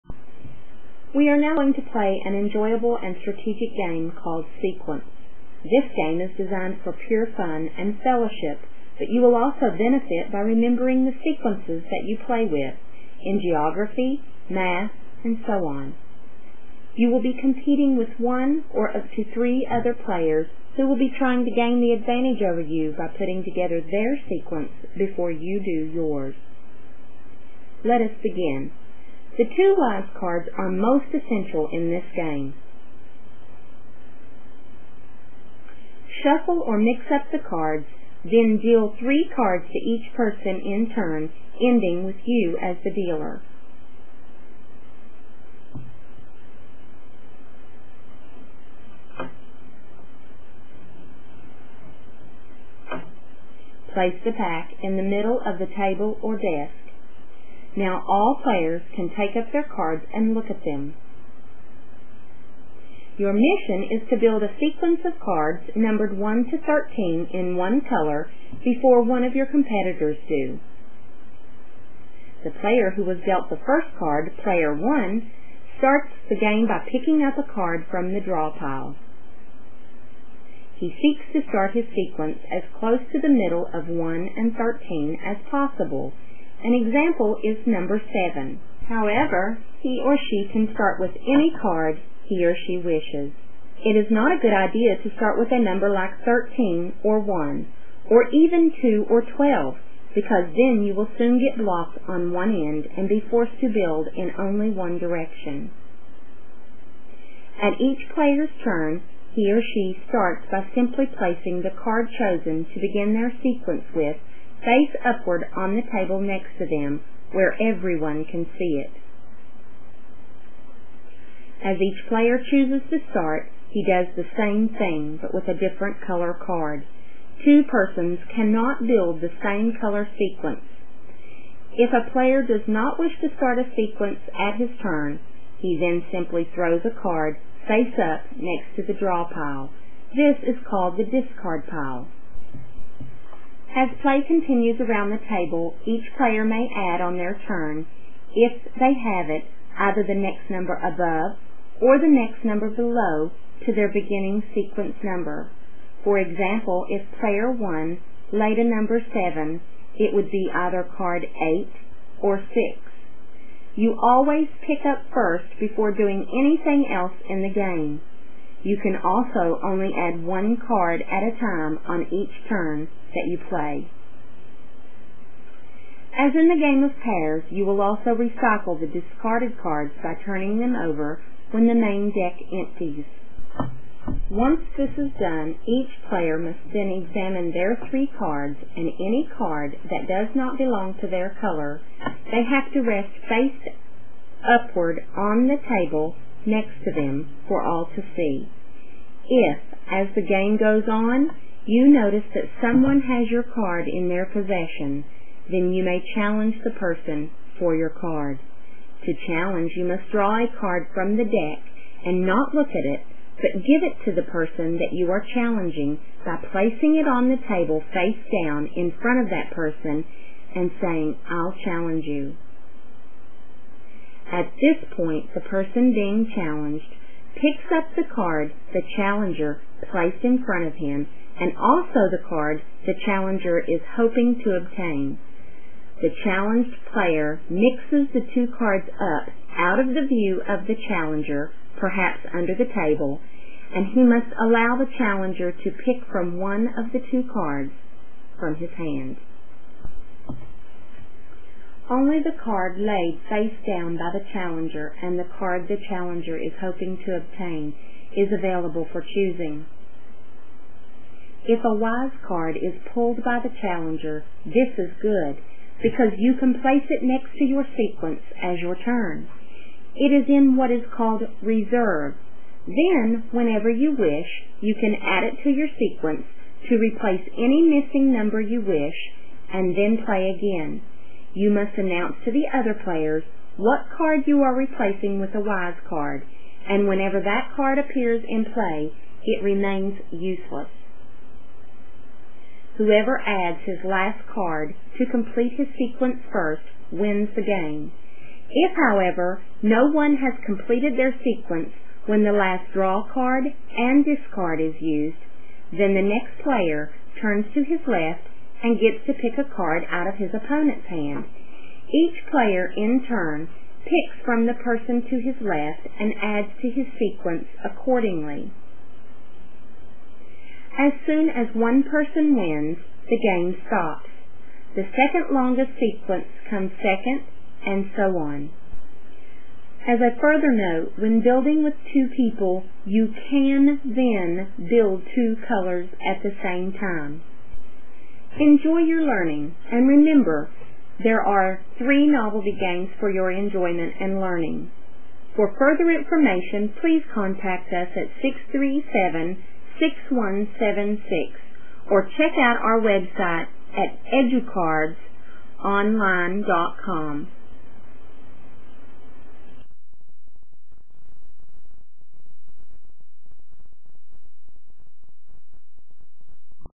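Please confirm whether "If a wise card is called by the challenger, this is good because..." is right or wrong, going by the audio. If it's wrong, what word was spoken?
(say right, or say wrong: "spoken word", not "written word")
wrong: "pulled", not "called".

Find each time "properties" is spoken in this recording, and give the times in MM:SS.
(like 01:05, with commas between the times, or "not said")
not said.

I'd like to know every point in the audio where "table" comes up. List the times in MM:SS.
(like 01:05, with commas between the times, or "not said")
00:55, 01:55, 02:25, 03:15, 03:37, 04:02.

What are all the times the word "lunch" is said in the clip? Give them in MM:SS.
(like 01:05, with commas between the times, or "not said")
not said.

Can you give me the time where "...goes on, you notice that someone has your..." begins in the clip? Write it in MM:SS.
03:20.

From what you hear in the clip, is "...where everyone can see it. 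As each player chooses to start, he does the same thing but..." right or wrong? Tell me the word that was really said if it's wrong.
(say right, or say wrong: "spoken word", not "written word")
right.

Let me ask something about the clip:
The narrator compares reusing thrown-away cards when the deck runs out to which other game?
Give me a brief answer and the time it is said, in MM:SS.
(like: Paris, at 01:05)
pairs, at 02:56.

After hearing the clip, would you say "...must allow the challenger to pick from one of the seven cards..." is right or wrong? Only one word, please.
wrong.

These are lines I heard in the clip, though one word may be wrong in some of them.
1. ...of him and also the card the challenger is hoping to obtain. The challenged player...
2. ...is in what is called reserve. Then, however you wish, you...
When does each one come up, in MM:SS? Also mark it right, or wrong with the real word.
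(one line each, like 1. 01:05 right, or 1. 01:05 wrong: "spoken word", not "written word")
1. 03:50 right
2. 04:30 wrong: "whenever", not "however".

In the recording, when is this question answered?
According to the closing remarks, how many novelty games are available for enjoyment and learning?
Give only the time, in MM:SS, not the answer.
05:41.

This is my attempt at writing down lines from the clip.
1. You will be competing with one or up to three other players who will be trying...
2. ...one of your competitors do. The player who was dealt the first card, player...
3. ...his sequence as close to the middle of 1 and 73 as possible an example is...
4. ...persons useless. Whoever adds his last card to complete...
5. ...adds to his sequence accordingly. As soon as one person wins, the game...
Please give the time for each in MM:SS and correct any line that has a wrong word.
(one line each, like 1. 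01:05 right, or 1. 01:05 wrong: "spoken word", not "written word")
1. 00:16 right
2. 01:09 right
3. 01:21 wrong: "13", not "73"
4. 04:49 wrong: "remains", not "persons"
5. 05:16 right.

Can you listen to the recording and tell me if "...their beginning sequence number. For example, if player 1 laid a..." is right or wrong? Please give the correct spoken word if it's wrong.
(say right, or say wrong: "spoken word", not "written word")
right.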